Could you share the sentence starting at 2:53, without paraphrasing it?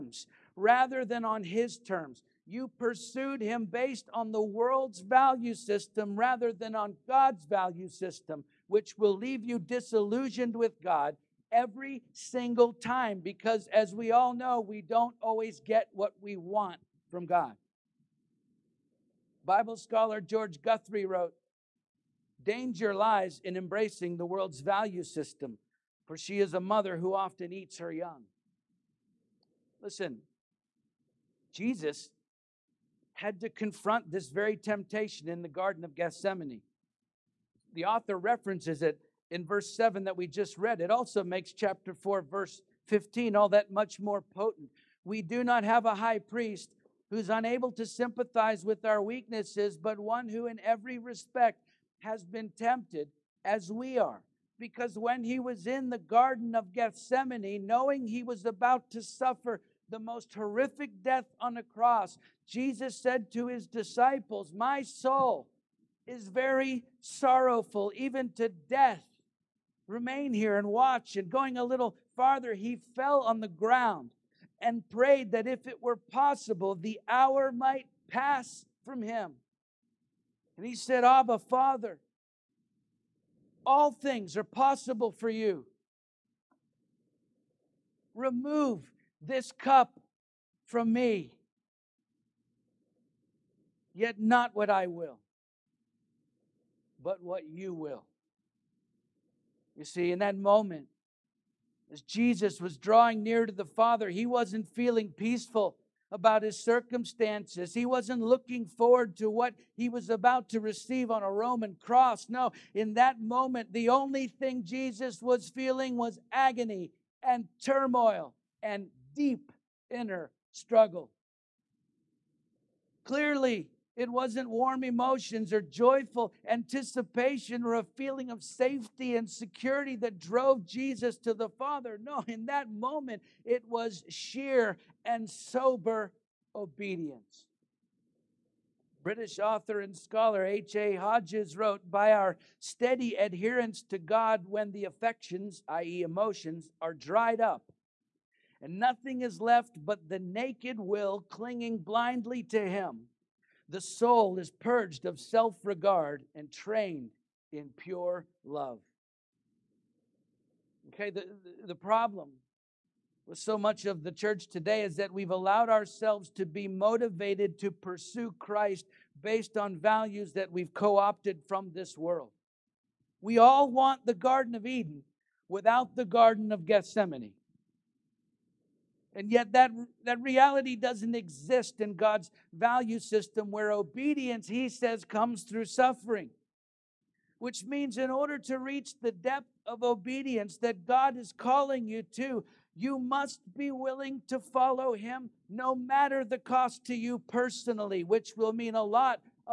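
We all want the Garden of Eden without the Garden of Gethsemane.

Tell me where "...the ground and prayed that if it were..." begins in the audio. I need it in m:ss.
1:13.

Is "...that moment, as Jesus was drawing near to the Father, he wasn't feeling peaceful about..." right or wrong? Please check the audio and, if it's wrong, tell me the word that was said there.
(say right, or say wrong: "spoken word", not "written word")
right.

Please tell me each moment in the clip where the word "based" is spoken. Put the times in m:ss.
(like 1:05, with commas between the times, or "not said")
0:03, 2:49.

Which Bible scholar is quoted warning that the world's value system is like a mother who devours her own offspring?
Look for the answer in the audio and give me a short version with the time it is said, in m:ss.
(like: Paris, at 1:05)
George Guthrie, at 0:20.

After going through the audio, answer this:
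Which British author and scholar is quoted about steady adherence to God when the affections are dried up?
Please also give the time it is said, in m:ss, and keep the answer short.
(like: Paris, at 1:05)
H.A. Hodges, at 2:20.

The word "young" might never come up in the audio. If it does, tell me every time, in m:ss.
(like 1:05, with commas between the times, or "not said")
0:27.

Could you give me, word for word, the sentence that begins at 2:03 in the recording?
Clearly, it wasn't warm emotions or joyful anticipation or a feeling of safety and security that drove Jesus to the Father.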